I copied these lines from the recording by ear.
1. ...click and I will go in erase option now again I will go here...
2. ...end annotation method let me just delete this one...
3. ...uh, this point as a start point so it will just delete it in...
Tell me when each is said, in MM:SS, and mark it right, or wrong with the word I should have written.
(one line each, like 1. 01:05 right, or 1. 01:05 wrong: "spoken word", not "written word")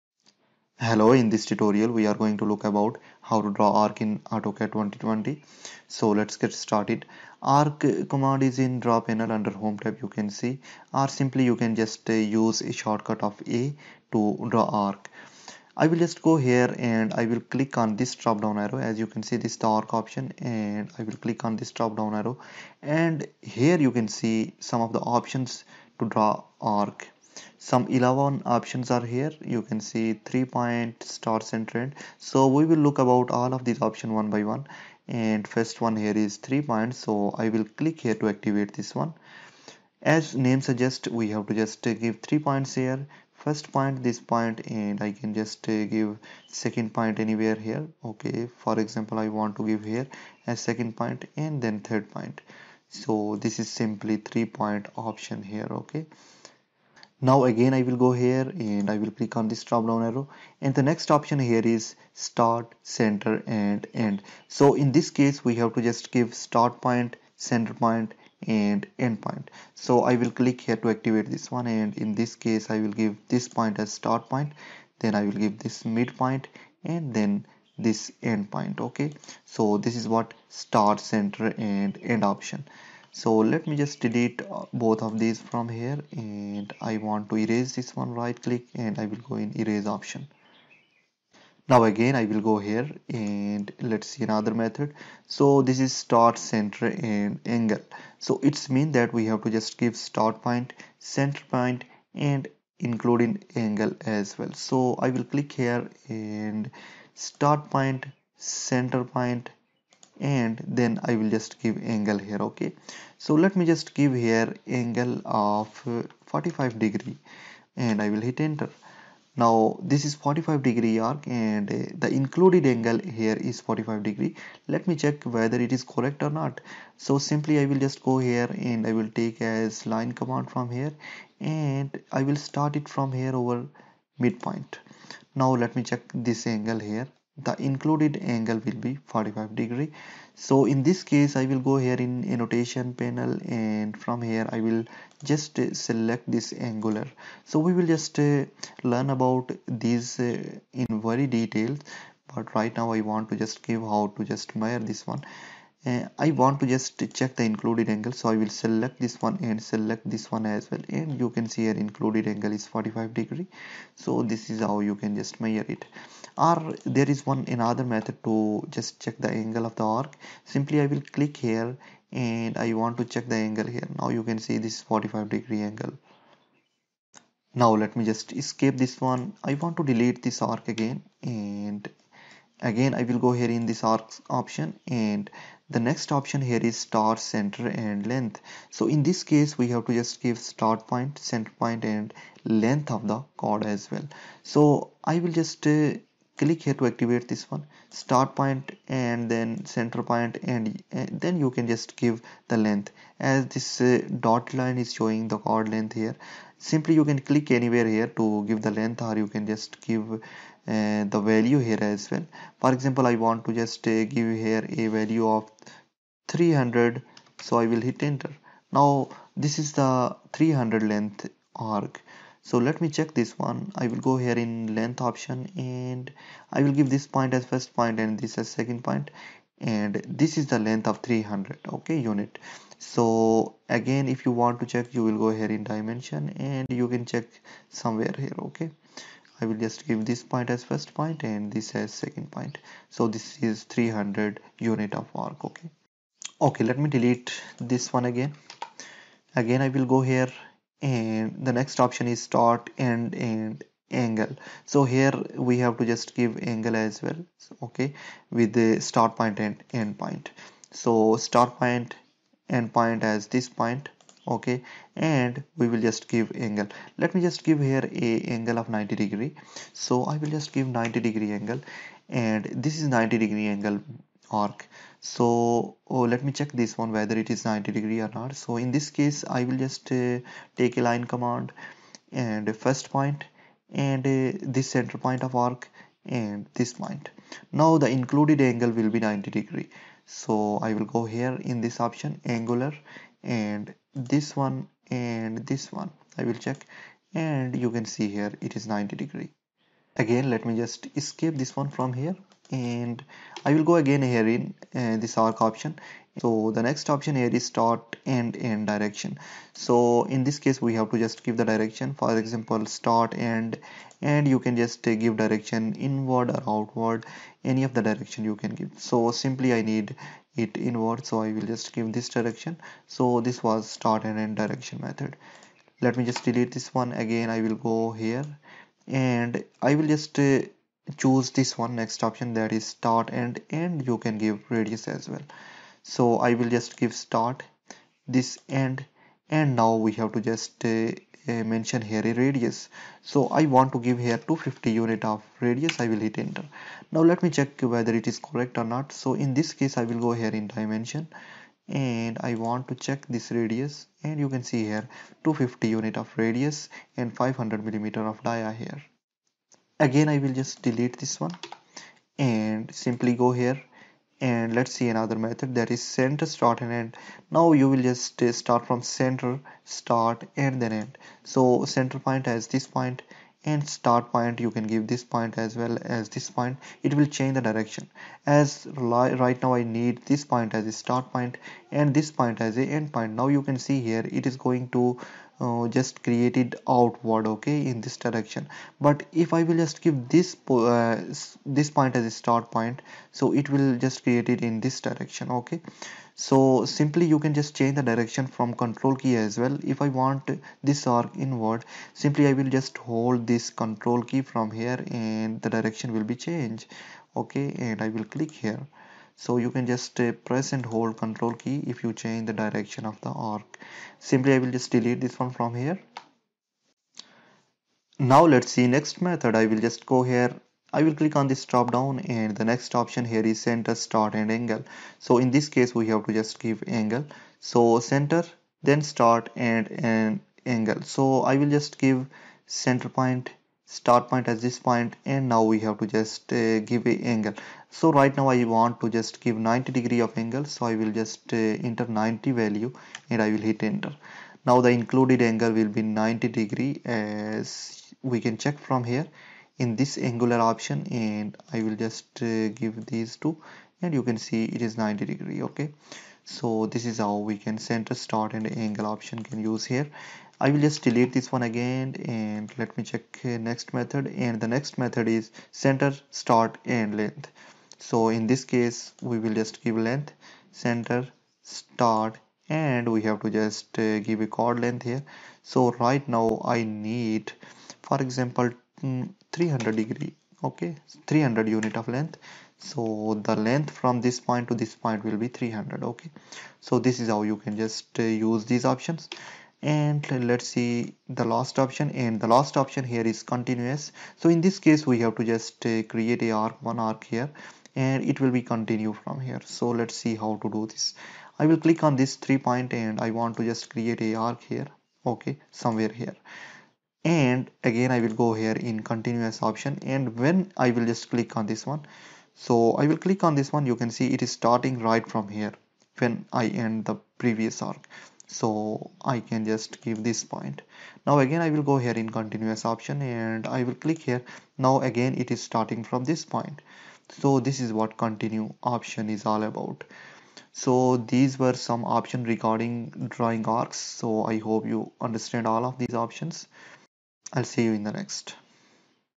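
1. 01:28 right
2. 05:24 wrong: "direction", not "annotation"
3. 06:30 wrong: "create", not "delete".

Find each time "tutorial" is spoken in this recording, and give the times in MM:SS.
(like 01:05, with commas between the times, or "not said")
00:01.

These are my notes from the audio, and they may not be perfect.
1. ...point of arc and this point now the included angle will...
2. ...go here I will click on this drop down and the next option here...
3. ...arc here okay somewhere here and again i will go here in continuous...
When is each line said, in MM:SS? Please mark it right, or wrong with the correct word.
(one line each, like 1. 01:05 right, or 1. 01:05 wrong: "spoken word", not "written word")
1. 04:44 right
2. 06:59 right
3. 08:24 right.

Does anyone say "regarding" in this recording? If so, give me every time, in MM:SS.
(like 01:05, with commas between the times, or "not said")
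08:52.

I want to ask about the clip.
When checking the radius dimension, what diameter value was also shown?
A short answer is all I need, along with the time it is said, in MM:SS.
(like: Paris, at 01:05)
500 millimeters, at 05:57.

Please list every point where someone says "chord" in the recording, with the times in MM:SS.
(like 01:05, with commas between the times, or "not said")
03:13, 03:25, 07:54.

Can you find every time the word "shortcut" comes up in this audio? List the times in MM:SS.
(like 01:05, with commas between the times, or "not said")
00:12.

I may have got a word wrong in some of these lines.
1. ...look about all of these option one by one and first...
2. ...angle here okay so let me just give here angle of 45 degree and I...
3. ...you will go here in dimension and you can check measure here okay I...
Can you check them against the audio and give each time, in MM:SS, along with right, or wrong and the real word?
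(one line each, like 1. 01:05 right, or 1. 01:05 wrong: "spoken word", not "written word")
1. 00:32 right
2. 01:51 right
3. 03:54 wrong: "somewhere", not "measure".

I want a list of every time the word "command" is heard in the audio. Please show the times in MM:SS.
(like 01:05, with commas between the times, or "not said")
00:08, 02:10, 04:41.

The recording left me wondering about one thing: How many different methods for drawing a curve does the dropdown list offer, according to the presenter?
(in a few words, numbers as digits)
11.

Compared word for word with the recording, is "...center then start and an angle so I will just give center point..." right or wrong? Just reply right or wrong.
right.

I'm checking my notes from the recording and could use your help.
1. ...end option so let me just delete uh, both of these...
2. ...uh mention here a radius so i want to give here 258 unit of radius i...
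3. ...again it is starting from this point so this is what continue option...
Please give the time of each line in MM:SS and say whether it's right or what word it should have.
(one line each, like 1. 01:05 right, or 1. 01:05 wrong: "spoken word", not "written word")
1. 01:22 right
2. 05:41 wrong: "250", not "258"
3. 08:44 right.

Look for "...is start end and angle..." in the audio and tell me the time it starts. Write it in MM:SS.
04:12.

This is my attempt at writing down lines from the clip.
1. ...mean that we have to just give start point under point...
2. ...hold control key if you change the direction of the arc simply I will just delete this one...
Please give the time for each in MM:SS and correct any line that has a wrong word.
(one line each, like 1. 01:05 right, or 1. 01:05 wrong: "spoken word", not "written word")
1. 01:38 wrong: "center", not "under"
2. 06:50 right.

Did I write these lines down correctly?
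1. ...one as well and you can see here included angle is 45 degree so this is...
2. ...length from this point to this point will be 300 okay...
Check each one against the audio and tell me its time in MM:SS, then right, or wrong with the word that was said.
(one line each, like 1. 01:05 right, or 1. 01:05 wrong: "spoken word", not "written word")
1. 02:40 right
2. 08:03 right.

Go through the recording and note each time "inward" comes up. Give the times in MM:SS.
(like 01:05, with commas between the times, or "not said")
05:15, 05:20, 06:41.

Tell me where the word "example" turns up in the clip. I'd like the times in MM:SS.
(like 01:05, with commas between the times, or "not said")
00:48, 03:32, 05:12, 07:58.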